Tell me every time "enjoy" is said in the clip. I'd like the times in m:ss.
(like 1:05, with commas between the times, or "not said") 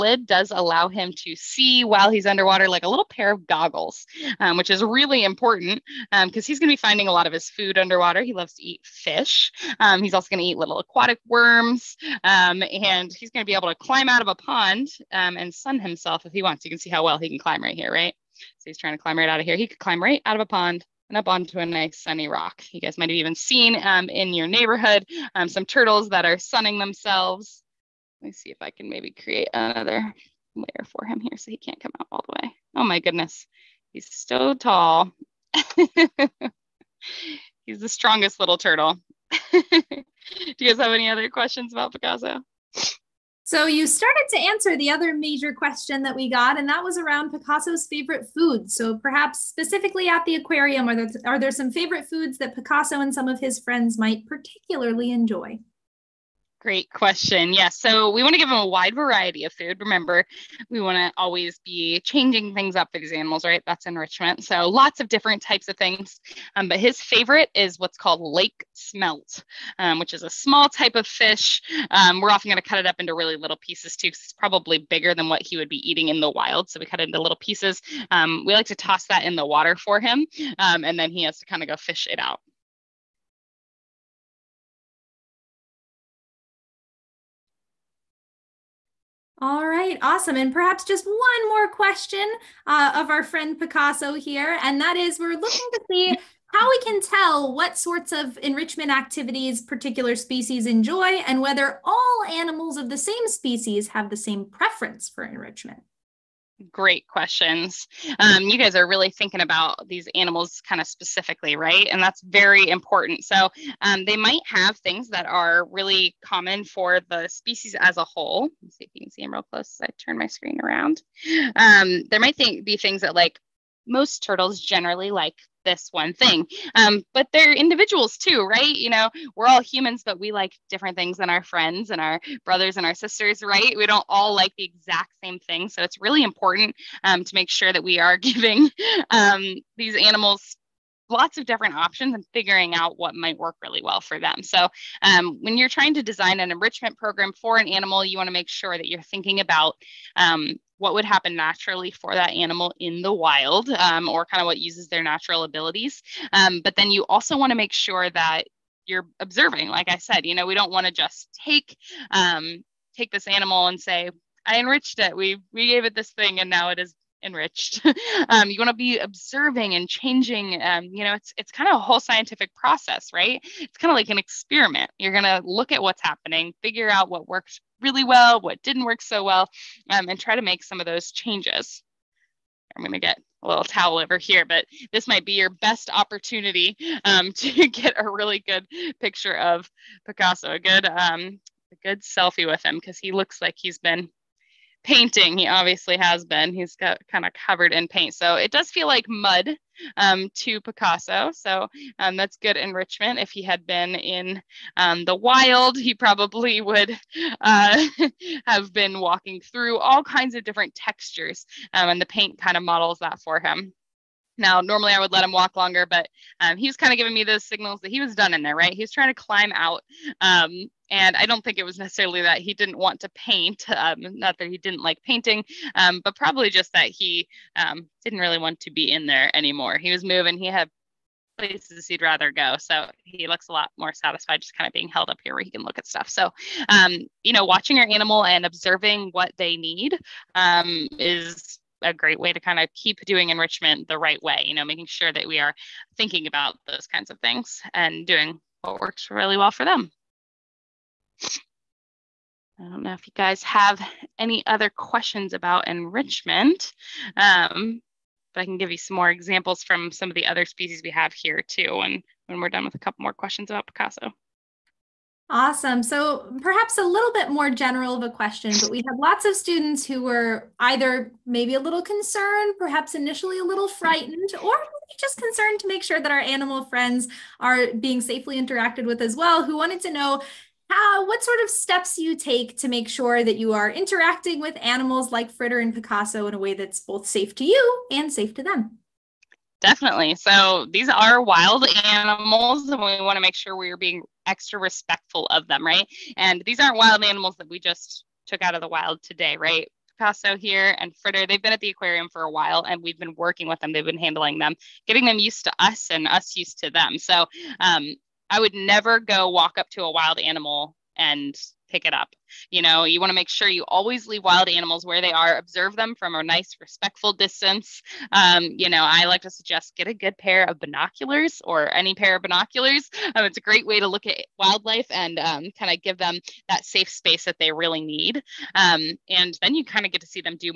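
0:55, 1:40.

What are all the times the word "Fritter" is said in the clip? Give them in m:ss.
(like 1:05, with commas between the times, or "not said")
4:45, 5:00.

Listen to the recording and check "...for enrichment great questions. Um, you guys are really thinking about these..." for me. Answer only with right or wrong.
right.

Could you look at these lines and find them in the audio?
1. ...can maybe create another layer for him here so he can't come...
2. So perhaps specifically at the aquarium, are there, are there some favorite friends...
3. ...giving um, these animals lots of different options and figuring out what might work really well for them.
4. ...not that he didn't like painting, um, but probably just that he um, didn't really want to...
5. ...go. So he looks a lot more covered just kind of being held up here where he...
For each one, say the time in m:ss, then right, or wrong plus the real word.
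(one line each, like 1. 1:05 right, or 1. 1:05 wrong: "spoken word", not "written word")
1. 0:28 right
2. 0:48 wrong: "foods", not "friends"
3. 2:18 right
4. 3:43 right
5. 3:52 wrong: "satisfied", not "covered".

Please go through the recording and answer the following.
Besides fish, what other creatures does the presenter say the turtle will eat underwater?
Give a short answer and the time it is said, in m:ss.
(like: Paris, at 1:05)
aquatic worms, at 0:10.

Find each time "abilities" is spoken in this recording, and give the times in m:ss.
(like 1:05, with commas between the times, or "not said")
2:35.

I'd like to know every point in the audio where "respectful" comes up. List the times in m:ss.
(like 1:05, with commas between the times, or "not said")
4:54, 5:16.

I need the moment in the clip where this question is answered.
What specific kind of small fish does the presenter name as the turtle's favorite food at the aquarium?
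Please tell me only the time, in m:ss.
1:08.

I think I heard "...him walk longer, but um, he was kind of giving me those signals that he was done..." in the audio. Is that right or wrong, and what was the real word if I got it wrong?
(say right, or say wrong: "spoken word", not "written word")
right.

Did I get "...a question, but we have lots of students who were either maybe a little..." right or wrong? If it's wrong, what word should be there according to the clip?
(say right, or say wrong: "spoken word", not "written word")
right.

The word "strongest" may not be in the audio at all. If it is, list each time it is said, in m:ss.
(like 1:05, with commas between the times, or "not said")
0:37.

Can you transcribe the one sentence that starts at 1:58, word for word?
Let's see if you can see them real close as I turn my screen around.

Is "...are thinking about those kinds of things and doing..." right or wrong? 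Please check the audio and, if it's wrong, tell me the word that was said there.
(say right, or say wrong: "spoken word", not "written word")
right.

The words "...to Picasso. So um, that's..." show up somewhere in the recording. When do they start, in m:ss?
3:20.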